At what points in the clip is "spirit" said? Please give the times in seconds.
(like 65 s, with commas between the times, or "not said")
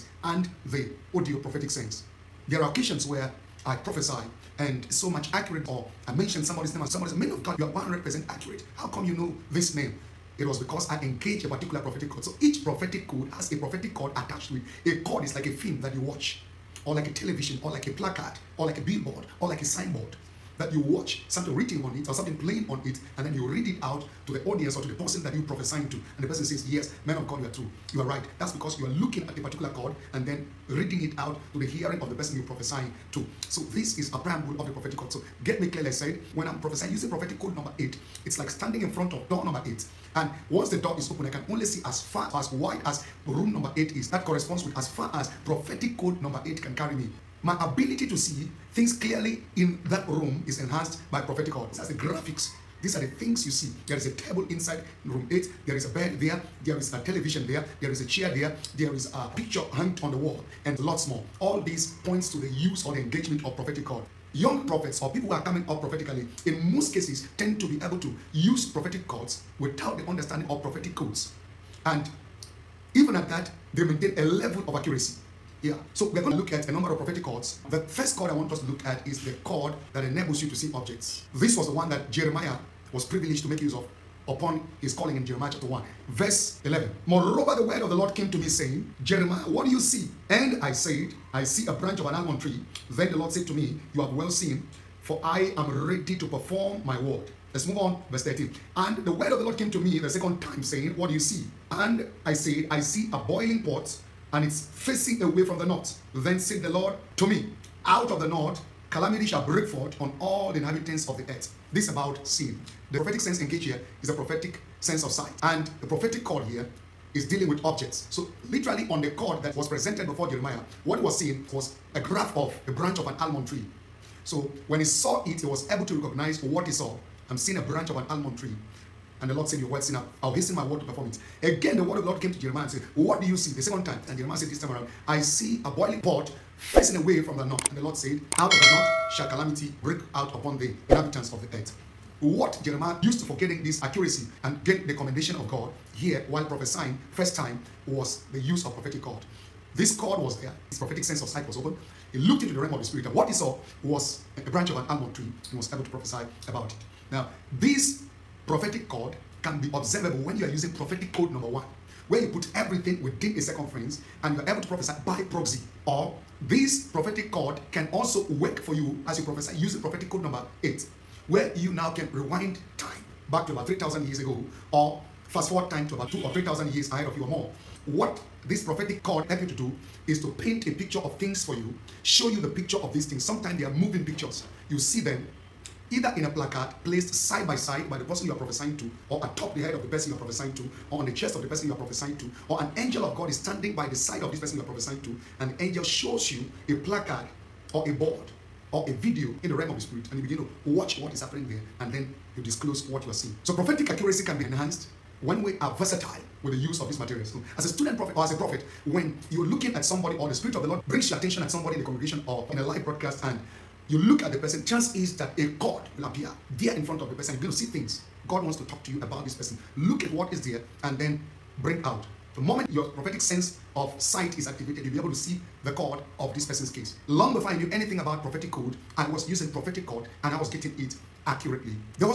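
152 s, 199 s, 210 s.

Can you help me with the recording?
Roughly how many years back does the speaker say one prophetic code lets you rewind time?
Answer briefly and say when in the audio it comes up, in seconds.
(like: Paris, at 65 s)
3000, at 173 s.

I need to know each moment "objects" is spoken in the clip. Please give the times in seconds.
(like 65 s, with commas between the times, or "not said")
80 s, 117 s.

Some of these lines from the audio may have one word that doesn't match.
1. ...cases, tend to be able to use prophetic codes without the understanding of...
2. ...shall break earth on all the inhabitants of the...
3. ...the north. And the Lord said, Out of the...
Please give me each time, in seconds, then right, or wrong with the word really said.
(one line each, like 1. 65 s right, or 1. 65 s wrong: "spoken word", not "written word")
1. 66 s right
2. 109 s wrong: "forth", not "earth"
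3. 137 s right.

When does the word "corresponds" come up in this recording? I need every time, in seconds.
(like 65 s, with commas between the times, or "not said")
44 s.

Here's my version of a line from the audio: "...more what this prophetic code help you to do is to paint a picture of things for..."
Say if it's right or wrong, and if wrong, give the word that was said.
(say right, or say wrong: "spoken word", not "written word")
right.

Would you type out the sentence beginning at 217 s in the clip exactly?
You're going to see things God wants to talk to you about this person.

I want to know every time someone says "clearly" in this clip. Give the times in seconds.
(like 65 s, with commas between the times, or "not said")
35 s, 48 s.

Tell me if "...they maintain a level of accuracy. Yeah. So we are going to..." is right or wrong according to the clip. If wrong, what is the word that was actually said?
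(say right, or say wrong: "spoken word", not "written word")
right.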